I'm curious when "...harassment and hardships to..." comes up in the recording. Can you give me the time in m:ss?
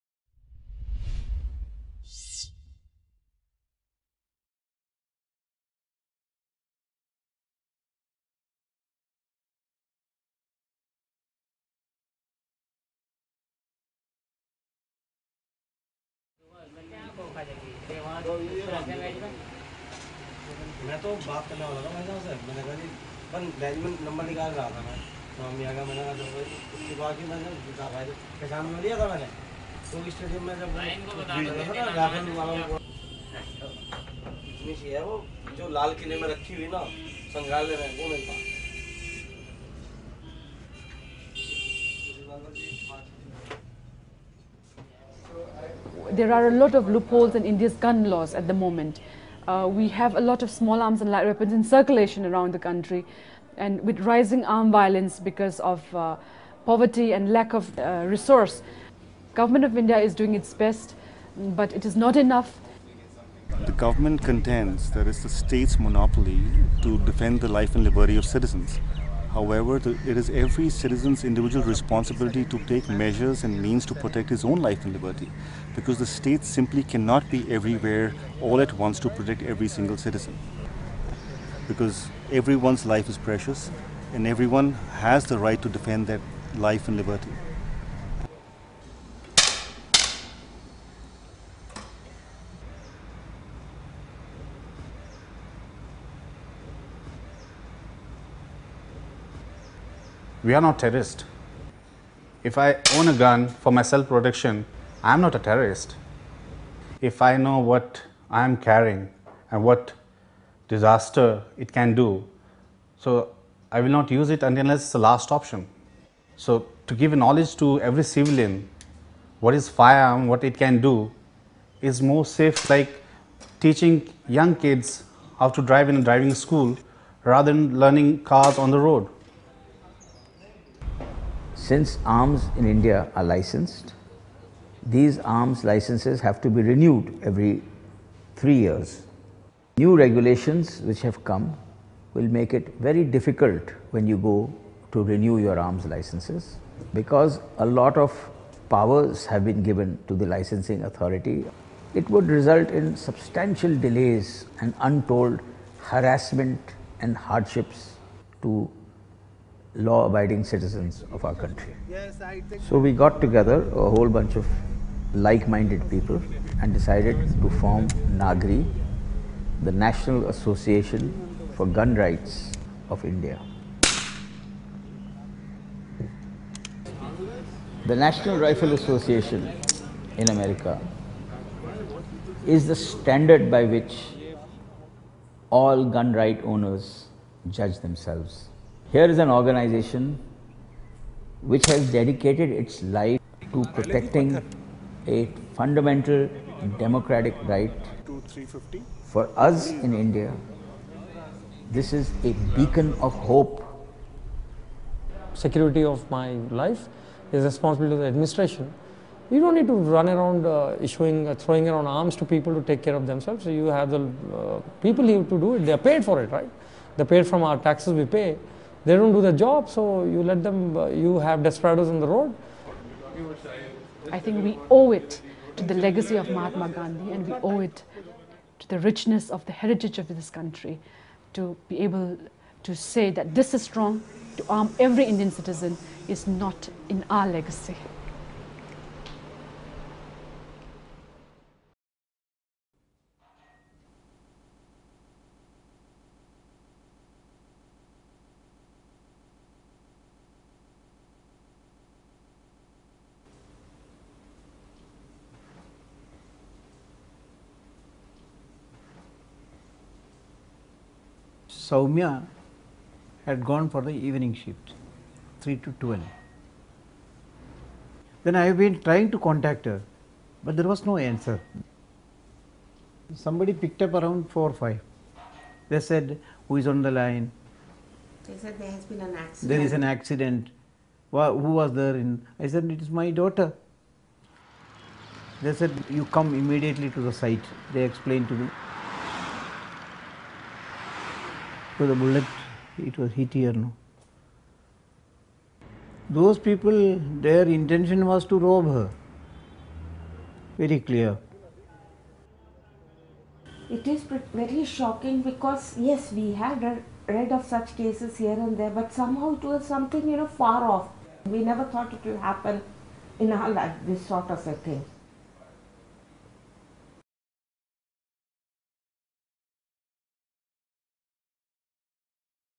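2:35.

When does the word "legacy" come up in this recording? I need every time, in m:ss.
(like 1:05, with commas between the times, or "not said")
3:45, 3:57.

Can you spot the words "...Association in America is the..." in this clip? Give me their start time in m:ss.
2:58.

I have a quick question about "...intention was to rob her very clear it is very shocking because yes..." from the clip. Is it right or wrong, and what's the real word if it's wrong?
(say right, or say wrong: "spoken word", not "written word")
right.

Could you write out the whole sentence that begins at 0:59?
Government of India is doing its best, but it is not enough.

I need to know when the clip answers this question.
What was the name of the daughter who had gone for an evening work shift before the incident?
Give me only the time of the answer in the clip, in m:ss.
4:21.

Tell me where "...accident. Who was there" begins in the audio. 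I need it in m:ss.
4:39.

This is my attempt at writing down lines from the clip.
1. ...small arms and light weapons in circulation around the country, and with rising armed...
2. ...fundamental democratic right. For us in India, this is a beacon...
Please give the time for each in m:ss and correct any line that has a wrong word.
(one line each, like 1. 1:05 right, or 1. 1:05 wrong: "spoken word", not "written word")
1. 0:50 right
2. 3:15 right.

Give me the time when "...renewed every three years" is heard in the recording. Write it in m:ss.
2:16.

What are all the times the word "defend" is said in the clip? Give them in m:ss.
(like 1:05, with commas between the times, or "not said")
1:06, 1:25.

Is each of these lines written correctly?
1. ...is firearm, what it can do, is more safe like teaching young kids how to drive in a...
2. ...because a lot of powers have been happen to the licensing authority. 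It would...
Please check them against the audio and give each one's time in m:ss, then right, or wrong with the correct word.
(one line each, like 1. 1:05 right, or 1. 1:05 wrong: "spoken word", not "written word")
1. 1:59 right
2. 2:26 wrong: "given", not "happen".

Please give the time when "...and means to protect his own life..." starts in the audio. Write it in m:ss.
1:13.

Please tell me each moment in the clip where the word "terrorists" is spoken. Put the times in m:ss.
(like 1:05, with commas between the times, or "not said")
1:40, 1:45.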